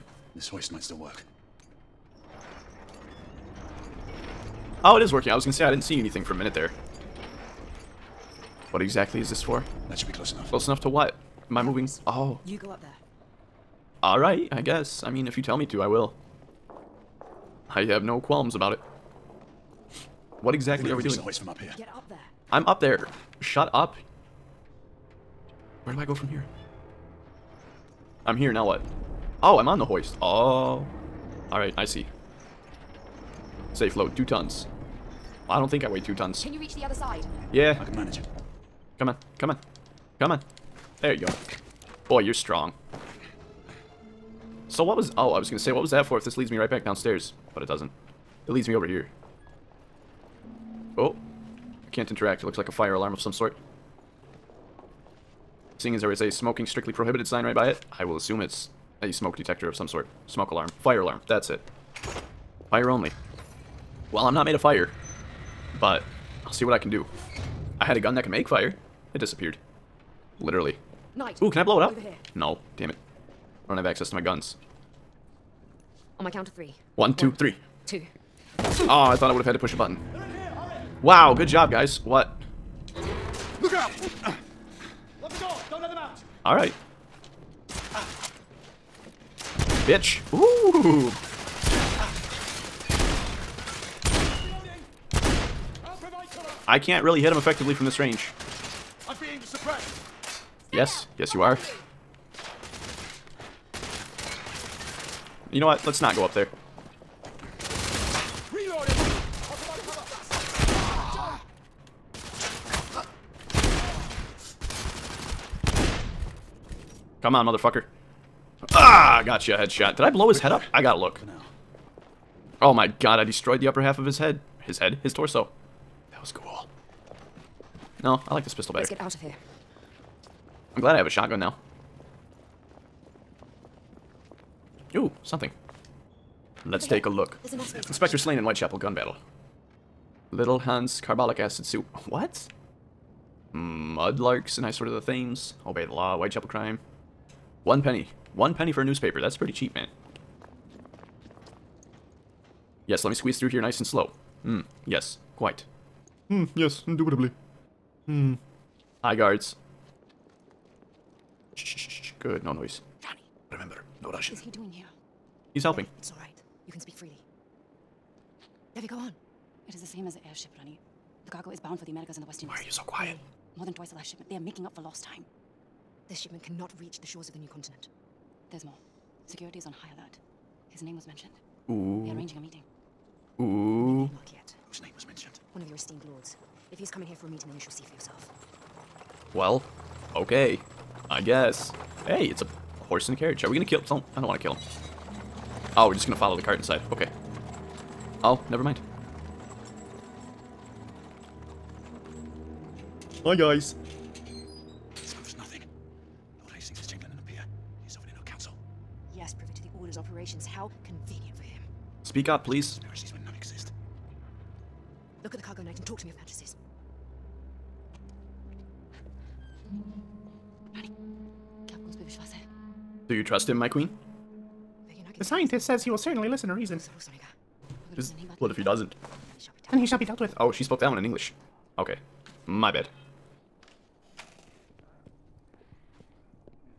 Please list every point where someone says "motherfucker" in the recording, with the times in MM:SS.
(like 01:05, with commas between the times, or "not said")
01:57.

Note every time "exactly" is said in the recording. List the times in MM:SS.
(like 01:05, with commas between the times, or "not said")
00:08, 00:20.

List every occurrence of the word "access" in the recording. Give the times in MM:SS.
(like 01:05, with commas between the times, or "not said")
01:13.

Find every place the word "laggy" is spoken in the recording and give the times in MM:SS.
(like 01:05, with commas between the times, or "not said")
not said.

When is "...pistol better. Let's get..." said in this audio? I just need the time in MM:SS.
02:08.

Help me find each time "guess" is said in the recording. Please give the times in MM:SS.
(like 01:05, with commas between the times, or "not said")
00:14, 03:11.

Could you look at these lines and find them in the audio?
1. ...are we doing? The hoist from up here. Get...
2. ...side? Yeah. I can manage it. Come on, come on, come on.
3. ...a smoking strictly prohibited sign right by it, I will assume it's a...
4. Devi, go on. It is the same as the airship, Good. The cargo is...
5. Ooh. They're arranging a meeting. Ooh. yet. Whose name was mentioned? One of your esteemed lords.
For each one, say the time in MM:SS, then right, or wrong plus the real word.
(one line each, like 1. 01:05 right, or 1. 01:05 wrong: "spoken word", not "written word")
1. 00:20 right
2. 00:36 right
3. 00:56 right
4. 02:48 wrong: "Rani", not "Good"
5. 03:01 right.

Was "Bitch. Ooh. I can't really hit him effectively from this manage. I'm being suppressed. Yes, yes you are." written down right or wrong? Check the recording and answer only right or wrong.
wrong.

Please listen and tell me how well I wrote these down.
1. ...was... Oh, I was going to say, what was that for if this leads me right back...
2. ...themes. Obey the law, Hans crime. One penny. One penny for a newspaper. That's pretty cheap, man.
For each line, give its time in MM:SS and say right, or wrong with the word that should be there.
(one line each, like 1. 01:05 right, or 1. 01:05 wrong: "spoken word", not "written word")
1. 00:44 right
2. 02:25 wrong: "Whitechapel", not "Hans".